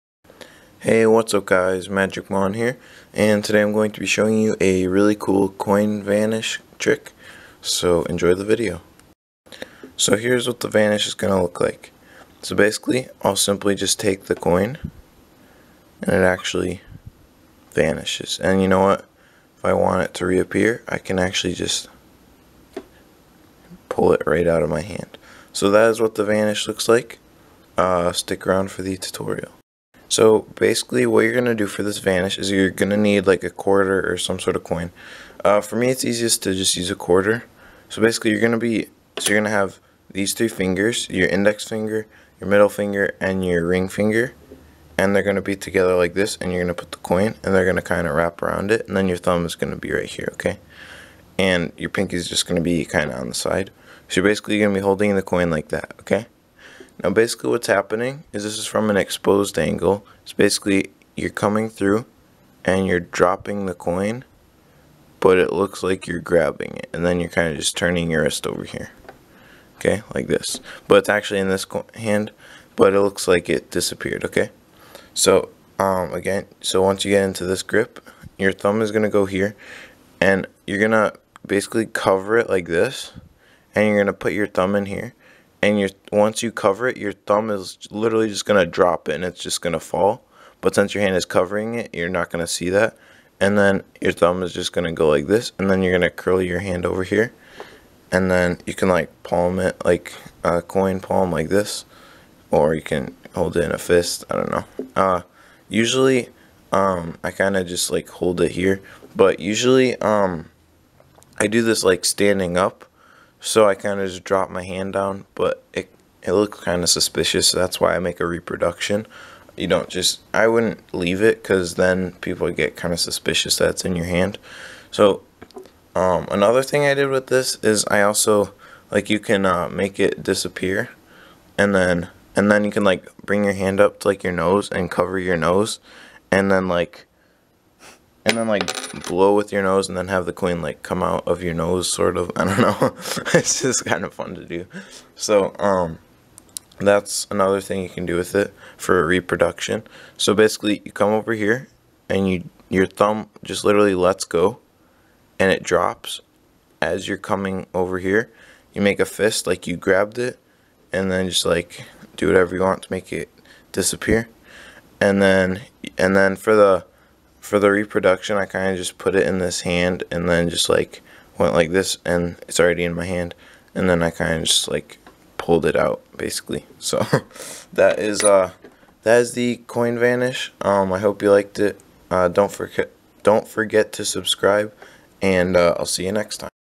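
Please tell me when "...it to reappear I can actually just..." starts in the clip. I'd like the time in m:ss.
0:20.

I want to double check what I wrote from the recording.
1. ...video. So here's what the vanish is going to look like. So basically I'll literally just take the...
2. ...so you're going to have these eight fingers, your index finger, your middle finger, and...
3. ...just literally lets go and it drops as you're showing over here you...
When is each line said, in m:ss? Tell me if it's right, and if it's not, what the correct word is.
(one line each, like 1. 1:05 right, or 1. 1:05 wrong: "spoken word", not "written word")
1. 0:08 wrong: "simply", not "literally"
2. 0:39 wrong: "three", not "eight"
3. 2:33 wrong: "coming", not "showing".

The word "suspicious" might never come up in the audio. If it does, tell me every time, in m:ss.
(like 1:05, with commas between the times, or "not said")
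1:56, 2:02.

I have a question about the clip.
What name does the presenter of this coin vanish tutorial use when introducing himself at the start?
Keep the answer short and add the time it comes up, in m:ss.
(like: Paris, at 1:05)
Magic Mon, at 0:01.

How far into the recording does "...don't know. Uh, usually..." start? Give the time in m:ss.
1:44.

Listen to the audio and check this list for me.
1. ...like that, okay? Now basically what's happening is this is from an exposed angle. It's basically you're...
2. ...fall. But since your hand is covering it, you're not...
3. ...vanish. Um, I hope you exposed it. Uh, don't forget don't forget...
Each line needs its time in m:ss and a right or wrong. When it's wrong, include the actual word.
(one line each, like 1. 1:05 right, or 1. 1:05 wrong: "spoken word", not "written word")
1. 0:55 right
2. 1:29 right
3. 2:59 wrong: "liked", not "exposed".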